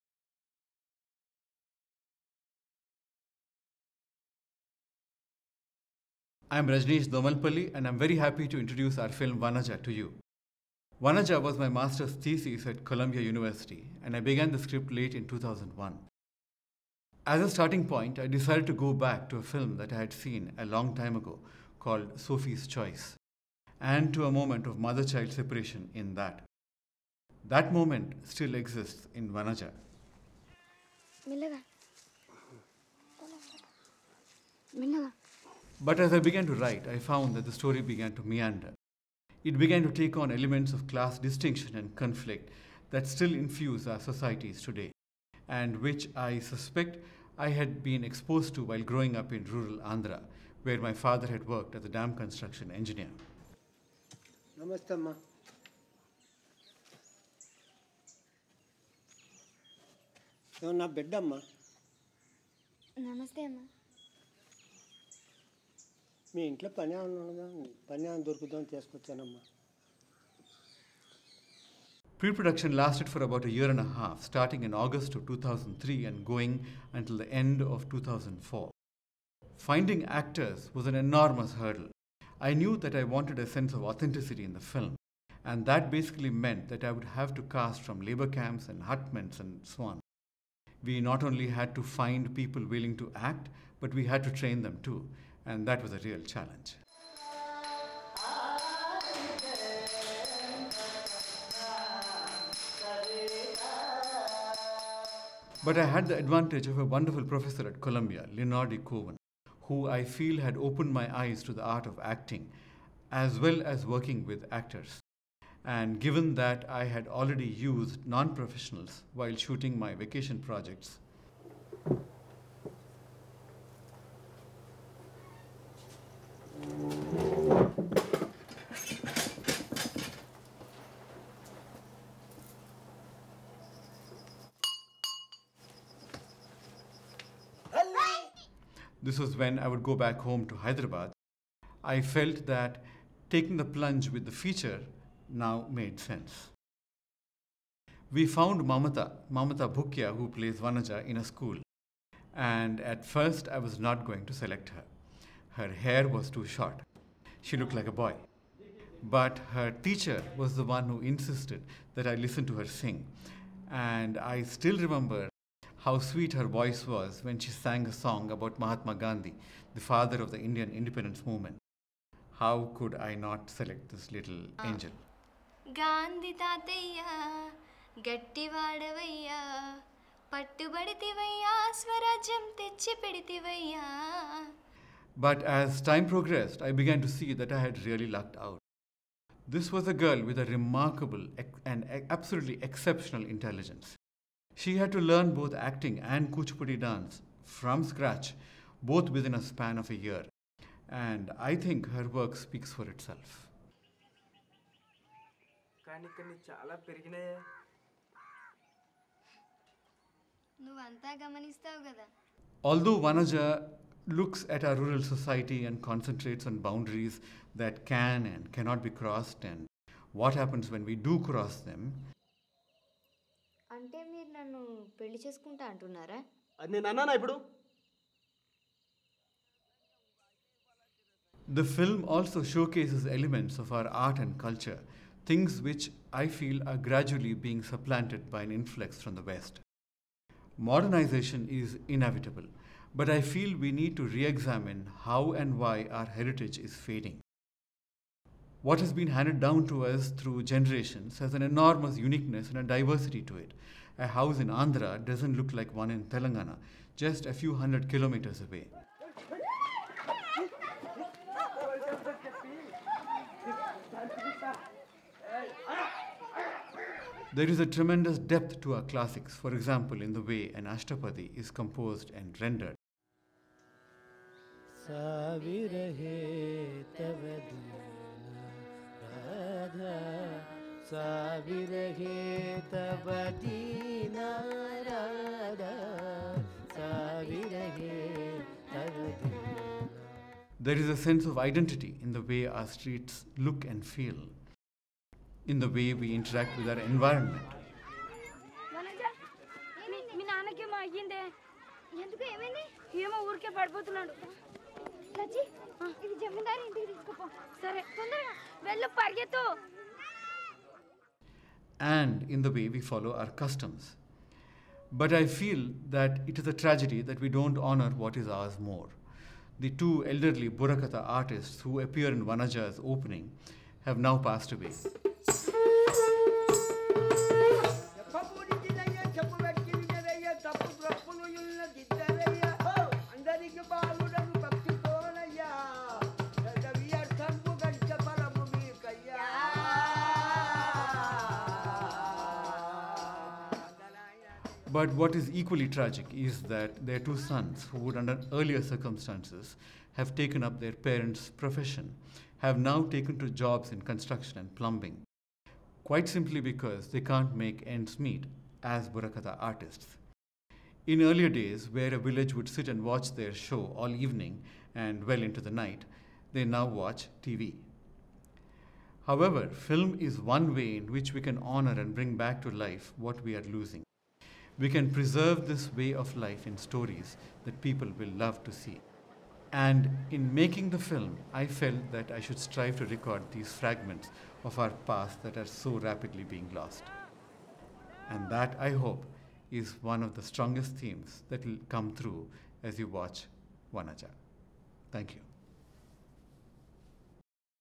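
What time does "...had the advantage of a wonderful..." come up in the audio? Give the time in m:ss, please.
1:45.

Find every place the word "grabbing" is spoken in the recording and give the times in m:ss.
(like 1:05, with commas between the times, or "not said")
not said.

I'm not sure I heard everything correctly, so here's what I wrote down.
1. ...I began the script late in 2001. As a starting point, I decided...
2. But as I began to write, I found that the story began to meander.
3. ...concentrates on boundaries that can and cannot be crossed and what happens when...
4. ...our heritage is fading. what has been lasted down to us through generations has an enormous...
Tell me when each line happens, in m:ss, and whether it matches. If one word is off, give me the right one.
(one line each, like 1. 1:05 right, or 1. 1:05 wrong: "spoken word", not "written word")
1. 0:14 right
2. 0:35 right
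3. 3:35 right
4. 4:05 wrong: "handed", not "lasted".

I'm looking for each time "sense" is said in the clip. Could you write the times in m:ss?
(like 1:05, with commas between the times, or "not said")
1:23, 2:25, 4:51.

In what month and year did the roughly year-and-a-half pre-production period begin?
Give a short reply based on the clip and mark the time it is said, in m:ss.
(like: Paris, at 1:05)
August 2003, at 1:14.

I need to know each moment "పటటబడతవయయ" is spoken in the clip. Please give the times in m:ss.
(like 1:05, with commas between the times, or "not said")
3:00.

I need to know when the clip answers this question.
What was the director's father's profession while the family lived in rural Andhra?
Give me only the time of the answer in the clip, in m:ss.
0:51.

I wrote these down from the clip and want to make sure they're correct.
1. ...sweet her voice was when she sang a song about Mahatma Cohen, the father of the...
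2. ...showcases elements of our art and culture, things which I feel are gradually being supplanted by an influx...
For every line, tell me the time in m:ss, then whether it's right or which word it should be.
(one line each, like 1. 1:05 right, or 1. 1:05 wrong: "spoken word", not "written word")
1. 2:45 wrong: "Gandhi", not "Cohen"
2. 3:52 right.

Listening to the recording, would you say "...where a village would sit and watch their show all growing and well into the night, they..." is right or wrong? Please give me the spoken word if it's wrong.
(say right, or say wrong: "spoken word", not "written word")
wrong: "evening", not "growing".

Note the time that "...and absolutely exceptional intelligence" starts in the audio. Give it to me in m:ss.
3:11.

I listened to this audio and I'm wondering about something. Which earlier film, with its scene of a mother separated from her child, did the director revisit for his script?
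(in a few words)
Sophie's Choice.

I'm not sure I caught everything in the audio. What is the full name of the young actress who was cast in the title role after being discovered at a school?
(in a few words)
Mamatha Bhukya.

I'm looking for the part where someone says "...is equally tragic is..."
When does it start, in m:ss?
5:45.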